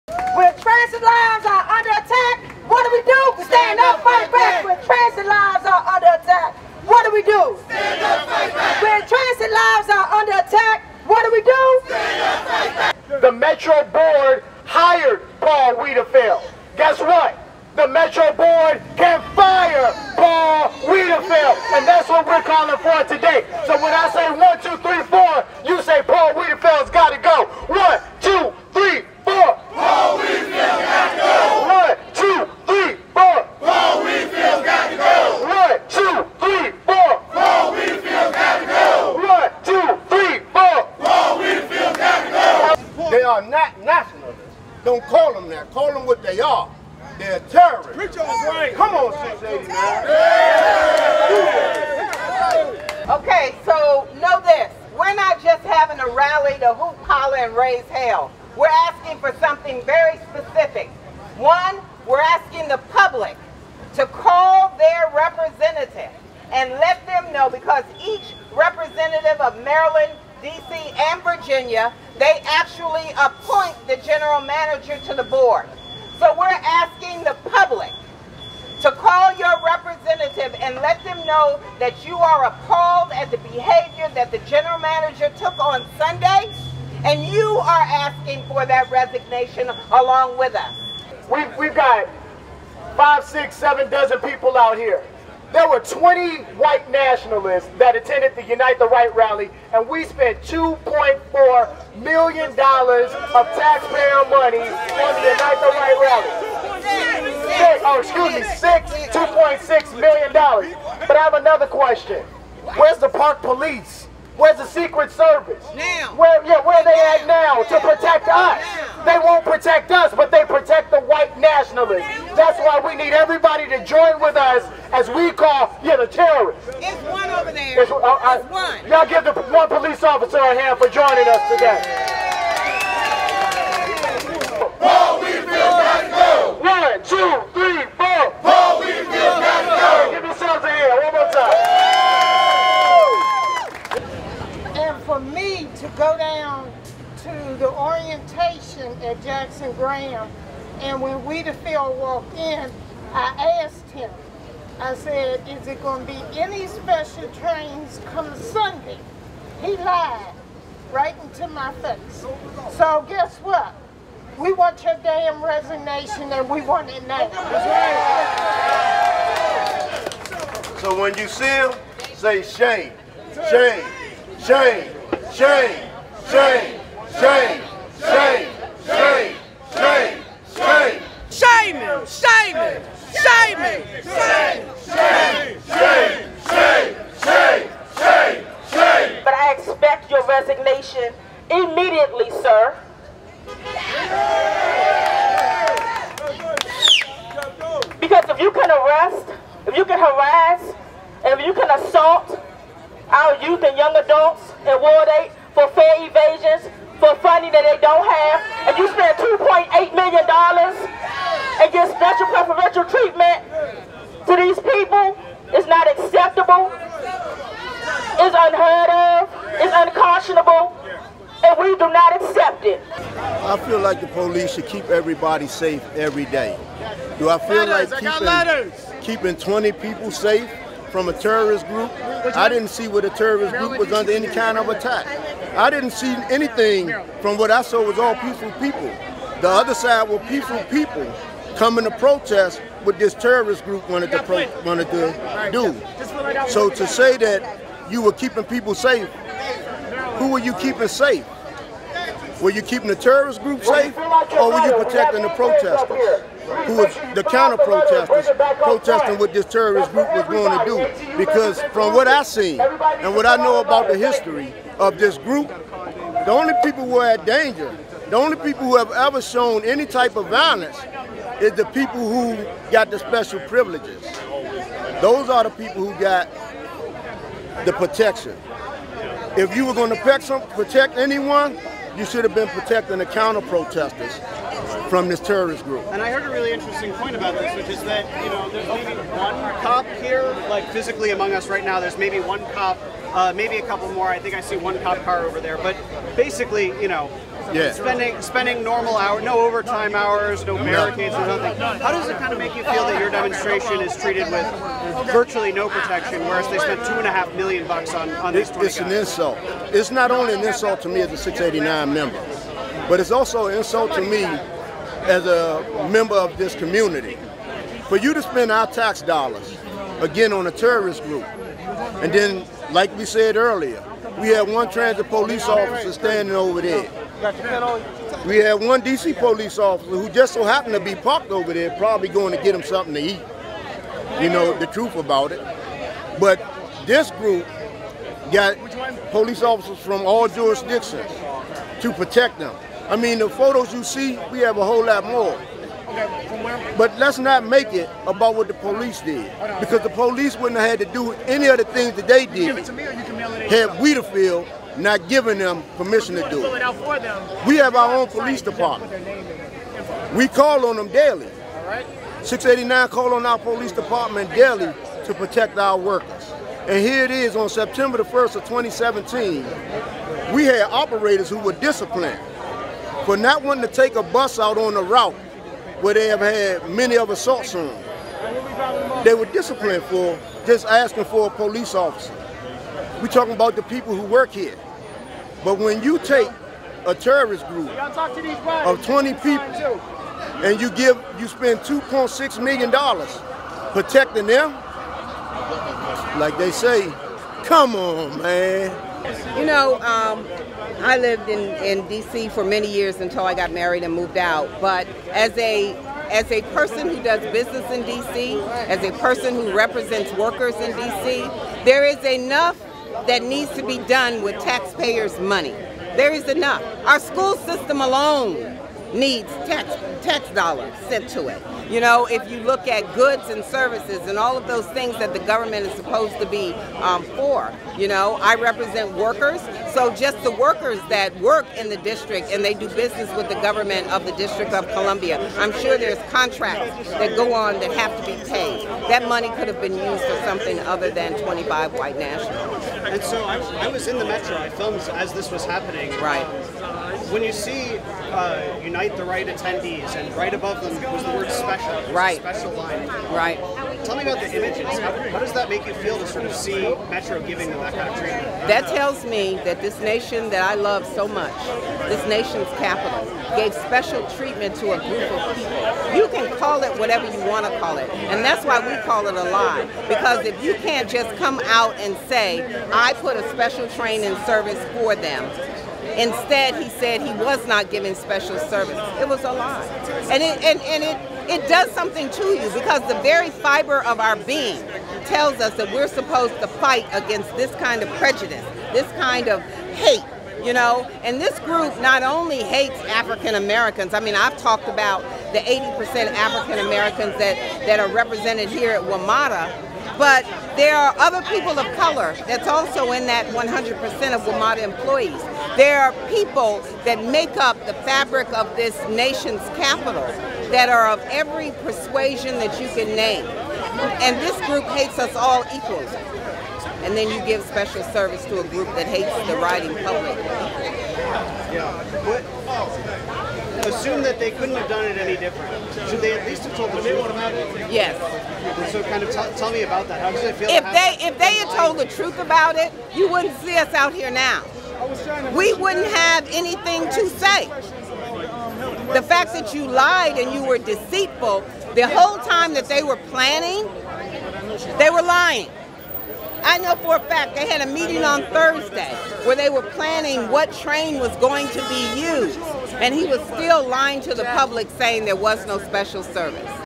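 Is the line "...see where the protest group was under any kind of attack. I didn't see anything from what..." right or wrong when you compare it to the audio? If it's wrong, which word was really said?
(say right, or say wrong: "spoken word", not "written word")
wrong: "terrorist", not "protest".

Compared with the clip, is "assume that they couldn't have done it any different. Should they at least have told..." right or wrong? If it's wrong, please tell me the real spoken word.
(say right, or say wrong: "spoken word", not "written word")
right.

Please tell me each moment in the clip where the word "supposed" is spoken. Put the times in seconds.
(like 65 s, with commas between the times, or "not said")
425 s, 485 s.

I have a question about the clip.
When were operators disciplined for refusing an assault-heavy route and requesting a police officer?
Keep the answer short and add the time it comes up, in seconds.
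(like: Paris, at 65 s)
September 1, 2017, at 367 s.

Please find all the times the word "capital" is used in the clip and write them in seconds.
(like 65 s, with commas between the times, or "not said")
462 s, 509 s.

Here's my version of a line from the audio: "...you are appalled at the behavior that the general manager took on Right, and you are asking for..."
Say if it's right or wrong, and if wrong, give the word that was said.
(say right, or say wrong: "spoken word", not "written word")
wrong: "Sunday", not "Right".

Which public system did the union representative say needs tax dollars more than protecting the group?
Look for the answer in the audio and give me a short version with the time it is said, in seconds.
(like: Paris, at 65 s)
school system, at 416 s.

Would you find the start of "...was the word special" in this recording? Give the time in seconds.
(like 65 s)
450 s.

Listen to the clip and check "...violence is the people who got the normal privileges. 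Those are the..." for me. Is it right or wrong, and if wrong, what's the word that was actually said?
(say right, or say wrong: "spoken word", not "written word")
wrong: "special", not "normal".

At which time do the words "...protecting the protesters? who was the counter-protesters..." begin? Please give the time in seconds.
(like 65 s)
254 s.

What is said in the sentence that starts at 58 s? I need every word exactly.
We're asking for something very specific.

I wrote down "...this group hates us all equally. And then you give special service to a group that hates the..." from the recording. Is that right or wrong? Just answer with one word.
right.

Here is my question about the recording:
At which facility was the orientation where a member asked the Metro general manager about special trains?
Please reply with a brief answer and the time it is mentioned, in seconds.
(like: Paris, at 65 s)
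Jackson Graham, at 149 s.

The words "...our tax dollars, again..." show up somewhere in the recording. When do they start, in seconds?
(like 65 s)
318 s.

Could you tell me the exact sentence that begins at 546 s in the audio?
I know for a fact they had a meeting on Thursday where they were planning what train was going to be used.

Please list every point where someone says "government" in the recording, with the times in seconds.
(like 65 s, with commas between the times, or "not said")
425 s, 433 s.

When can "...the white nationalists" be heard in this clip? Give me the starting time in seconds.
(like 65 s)
120 s.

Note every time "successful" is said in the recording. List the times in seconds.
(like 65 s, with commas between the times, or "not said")
not said.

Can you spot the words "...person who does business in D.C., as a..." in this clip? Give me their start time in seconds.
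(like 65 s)
406 s.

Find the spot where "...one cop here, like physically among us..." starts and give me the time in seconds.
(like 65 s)
288 s.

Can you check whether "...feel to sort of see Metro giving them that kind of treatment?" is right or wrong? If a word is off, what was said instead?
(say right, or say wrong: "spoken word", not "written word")
right.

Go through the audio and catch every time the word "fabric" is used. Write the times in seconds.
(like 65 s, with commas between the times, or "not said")
507 s.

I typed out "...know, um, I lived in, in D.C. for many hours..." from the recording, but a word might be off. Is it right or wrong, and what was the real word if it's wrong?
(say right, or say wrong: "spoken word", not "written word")
wrong: "years", not "hours".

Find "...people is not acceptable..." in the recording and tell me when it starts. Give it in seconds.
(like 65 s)
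214 s.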